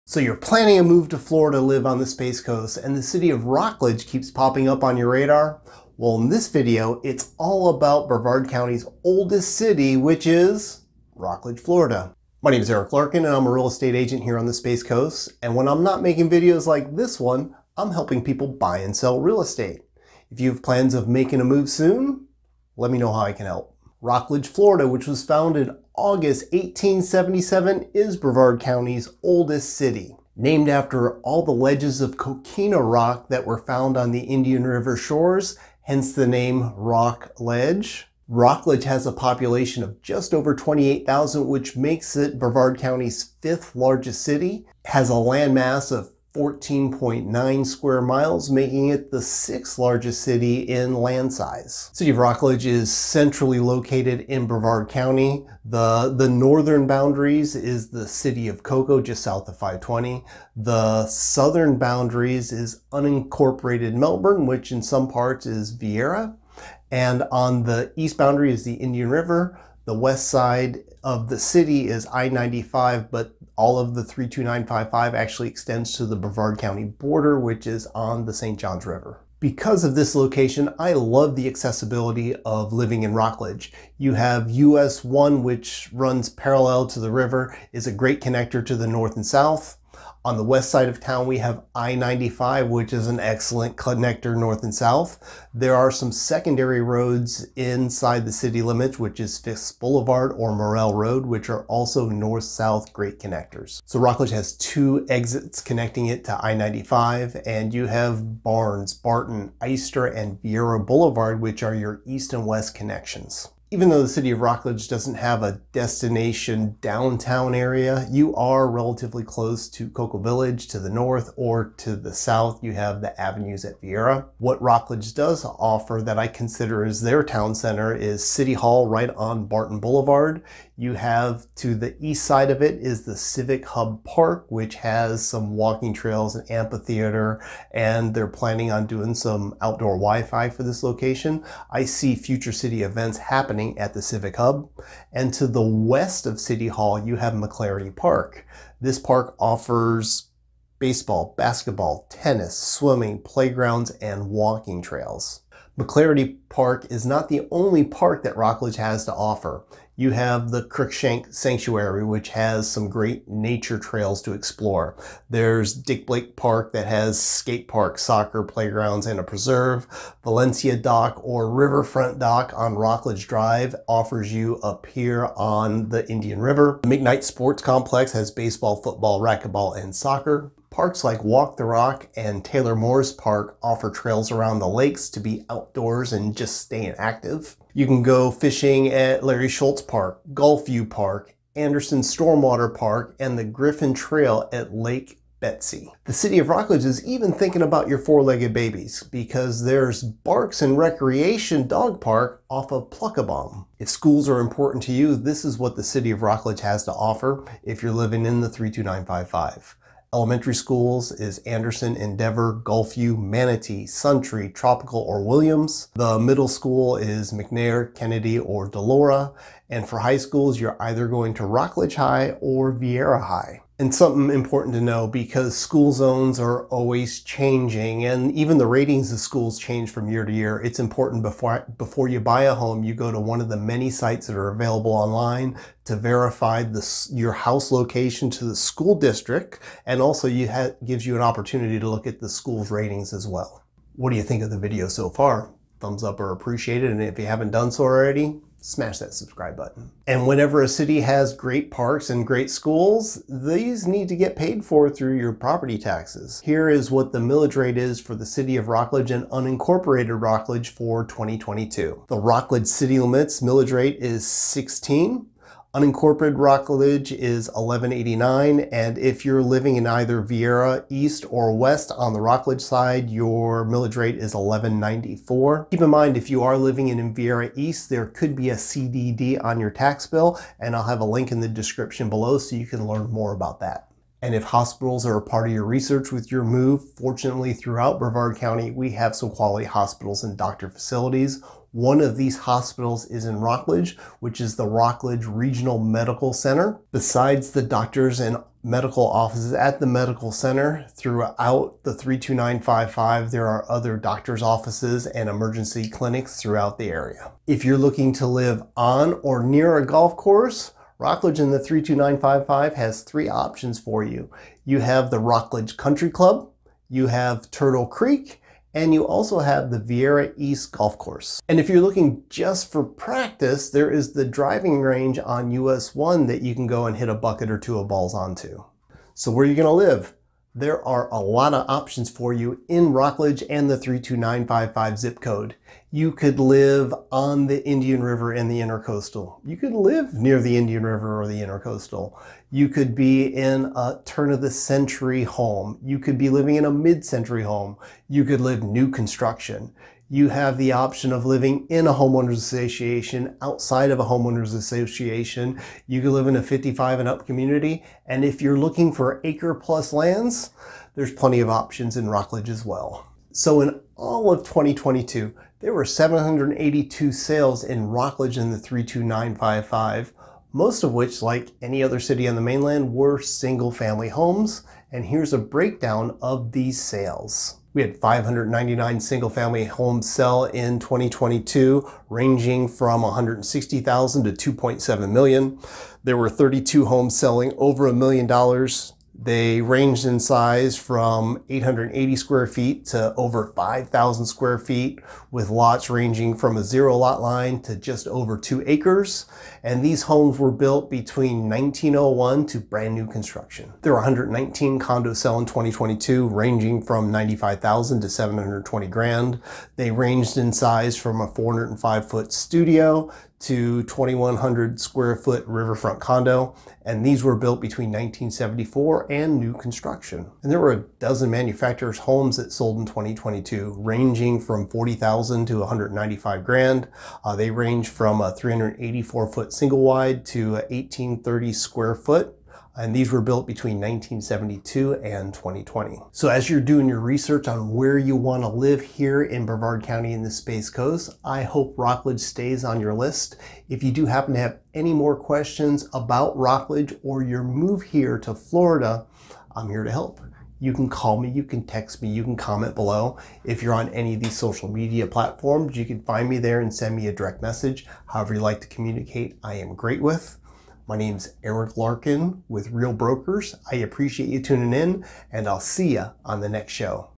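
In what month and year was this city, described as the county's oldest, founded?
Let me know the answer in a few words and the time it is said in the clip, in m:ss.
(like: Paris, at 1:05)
August 1877, at 0:26.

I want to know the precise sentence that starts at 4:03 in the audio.
What do you think of the video so far?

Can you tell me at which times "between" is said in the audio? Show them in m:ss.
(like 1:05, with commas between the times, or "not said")
6:40, 6:57, 7:13.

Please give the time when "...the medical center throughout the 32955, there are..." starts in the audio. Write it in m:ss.
4:59.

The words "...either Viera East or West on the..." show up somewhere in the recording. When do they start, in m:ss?
4:29.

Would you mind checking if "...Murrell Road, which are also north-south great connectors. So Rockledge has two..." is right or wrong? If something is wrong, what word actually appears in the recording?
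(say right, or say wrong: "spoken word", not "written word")
right.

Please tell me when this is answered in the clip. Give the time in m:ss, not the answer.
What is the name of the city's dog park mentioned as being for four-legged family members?
3:20.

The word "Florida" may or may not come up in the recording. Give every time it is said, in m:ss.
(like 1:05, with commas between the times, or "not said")
0:01, 0:11, 0:24, 7:28.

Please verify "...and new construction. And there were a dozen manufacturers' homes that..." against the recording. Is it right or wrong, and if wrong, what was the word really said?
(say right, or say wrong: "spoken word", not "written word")
right.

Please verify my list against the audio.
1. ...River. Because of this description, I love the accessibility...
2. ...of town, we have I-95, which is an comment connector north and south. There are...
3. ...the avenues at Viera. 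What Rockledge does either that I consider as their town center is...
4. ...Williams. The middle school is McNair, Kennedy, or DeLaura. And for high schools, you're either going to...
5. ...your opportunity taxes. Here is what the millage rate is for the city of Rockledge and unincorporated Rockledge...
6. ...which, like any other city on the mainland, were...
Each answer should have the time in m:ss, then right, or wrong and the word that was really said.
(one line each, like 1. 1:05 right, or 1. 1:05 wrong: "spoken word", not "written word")
1. 1:18 wrong: "location", not "description"
2. 1:30 wrong: "excellent", not "comment"
3. 2:02 wrong: "offer", not "either"
4. 3:35 right
5. 4:15 wrong: "property", not "opportunity"
6. 6:10 right.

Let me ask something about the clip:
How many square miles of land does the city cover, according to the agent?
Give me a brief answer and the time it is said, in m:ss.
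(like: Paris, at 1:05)
14.9, at 0:46.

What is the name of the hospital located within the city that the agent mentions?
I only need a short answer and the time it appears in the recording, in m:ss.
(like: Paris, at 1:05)
Rockledge Regional Medical Center, at 4:54.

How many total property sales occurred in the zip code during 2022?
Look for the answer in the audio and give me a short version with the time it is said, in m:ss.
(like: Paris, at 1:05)
782, at 6:05.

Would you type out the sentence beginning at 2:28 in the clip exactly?
This park offers baseball, basketball, tennis, swimming, playgrounds, and walking trails.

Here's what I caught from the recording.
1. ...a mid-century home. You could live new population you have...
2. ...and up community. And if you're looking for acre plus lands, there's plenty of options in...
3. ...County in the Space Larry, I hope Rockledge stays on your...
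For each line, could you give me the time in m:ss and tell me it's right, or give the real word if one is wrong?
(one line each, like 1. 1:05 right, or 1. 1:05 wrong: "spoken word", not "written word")
1. 5:46 wrong: "construction", not "population"
2. 5:56 right
3. 7:19 wrong: "Coast", not "Larry".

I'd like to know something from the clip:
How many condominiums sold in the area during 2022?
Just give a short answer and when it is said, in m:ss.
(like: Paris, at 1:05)
119, at 6:43.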